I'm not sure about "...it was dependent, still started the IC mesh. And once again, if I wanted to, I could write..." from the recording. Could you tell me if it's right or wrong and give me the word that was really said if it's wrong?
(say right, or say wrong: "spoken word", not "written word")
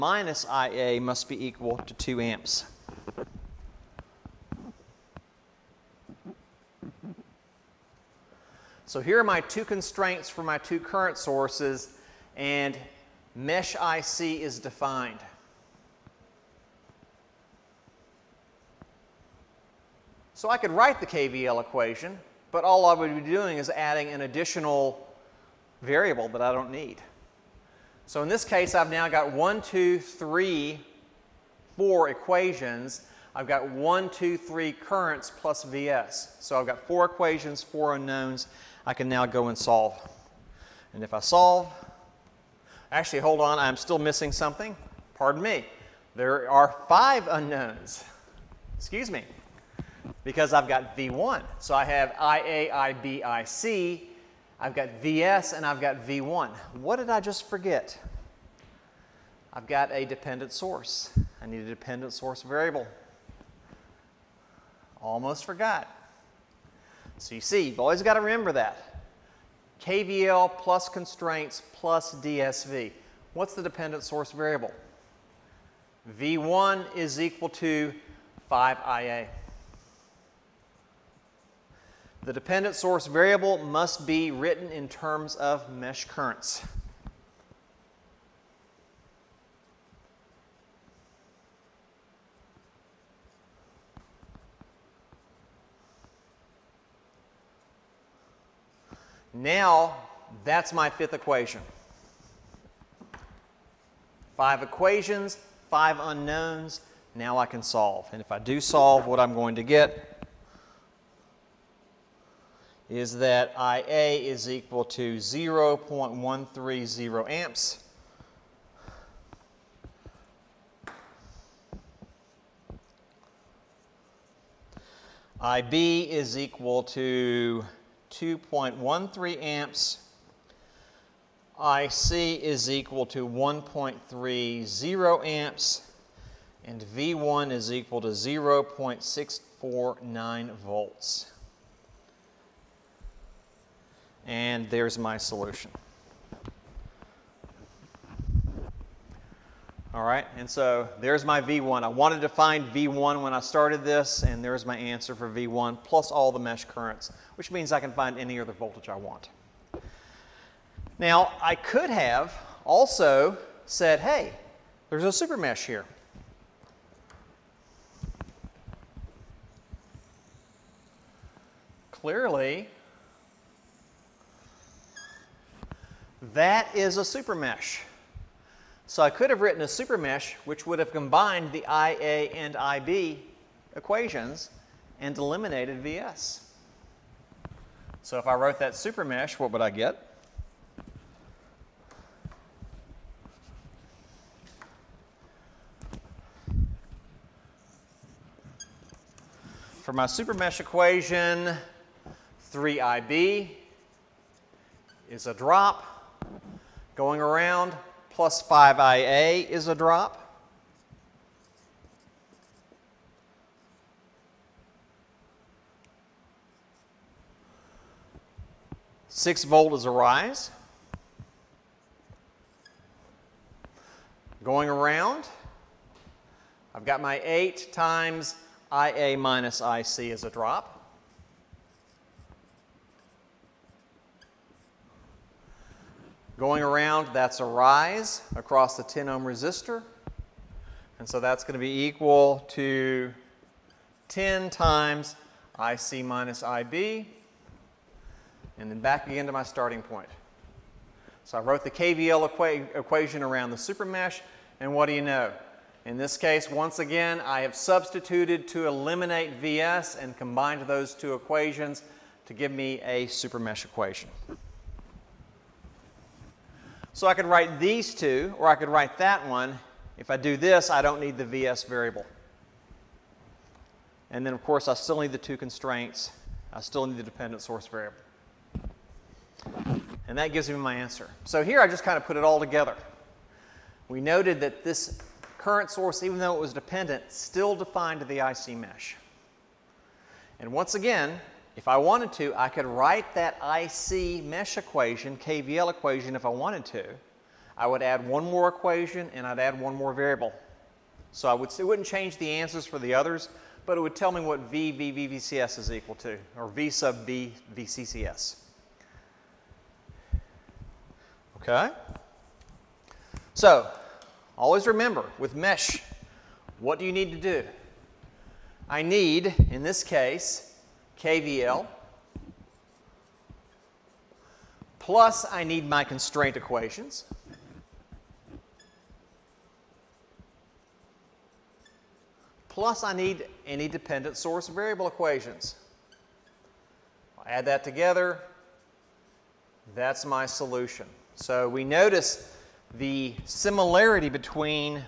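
wrong: "defined", not "started".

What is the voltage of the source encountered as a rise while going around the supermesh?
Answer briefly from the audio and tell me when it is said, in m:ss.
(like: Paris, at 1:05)
6 volts, at 3:39.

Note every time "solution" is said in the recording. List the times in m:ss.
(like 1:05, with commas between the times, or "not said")
2:25, 5:40.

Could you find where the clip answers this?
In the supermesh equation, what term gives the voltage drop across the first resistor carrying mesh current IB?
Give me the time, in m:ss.
3:22.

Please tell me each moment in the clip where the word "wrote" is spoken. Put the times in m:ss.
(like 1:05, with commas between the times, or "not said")
3:08, 4:11.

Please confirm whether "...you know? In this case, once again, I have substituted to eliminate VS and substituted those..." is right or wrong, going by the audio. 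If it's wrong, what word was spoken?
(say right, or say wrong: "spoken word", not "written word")
wrong: "combined", not "substituted".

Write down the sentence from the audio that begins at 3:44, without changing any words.
Going around, I've got my eight times IA minus IC is a drop.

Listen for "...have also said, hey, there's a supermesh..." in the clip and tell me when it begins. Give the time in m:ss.
2:41.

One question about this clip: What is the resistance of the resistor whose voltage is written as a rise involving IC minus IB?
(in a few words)
10 ohms.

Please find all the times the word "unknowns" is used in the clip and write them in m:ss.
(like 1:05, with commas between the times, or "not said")
0:37, 0:47, 1:45.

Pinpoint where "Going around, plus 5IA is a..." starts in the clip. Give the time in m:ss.
3:26.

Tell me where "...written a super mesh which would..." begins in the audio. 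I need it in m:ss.
2:59.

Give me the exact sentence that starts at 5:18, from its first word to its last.
I need, in this case, KVL, plus I need my constraint equations.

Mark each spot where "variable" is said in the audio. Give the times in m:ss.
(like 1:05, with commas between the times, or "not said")
0:25, 1:02, 1:14, 1:23, 4:31, 4:37, 4:59, 5:34.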